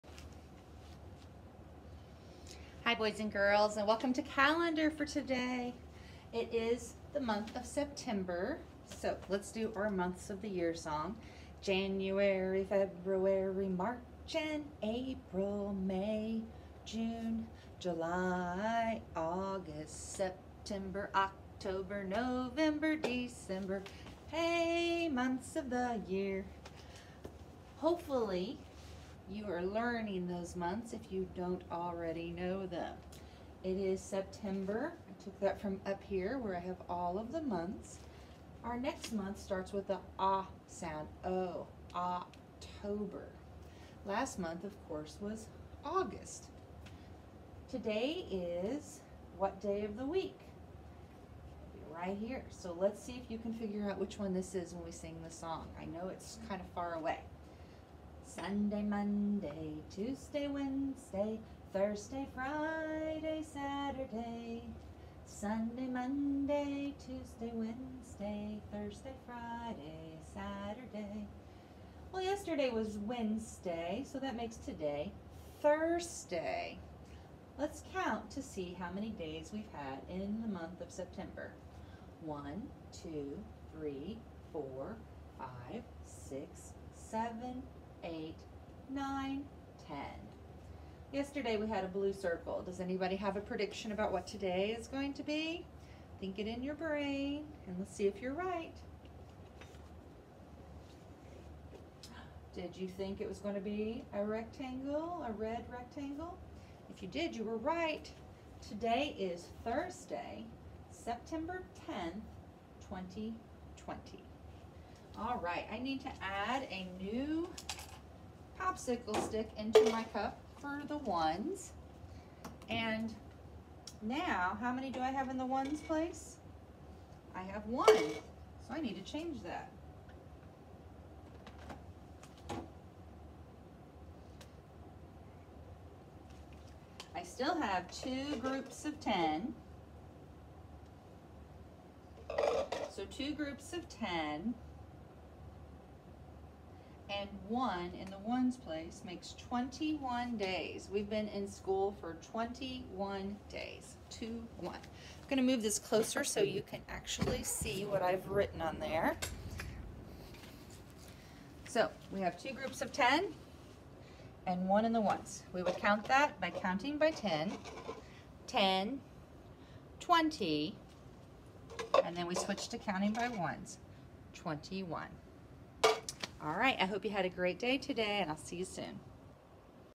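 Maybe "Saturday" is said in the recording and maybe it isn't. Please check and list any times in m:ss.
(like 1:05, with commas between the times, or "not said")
1:03, 1:10.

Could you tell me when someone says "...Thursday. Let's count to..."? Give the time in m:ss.
1:15.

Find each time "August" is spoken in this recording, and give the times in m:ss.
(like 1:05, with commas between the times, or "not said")
0:19, 0:45.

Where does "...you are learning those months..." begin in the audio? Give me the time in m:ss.
0:29.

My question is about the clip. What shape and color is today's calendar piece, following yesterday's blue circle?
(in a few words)
red rectangle.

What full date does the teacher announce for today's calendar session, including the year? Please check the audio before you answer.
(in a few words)
Thursday, September 10th, 2020.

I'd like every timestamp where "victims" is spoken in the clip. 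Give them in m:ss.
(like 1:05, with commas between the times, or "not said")
not said.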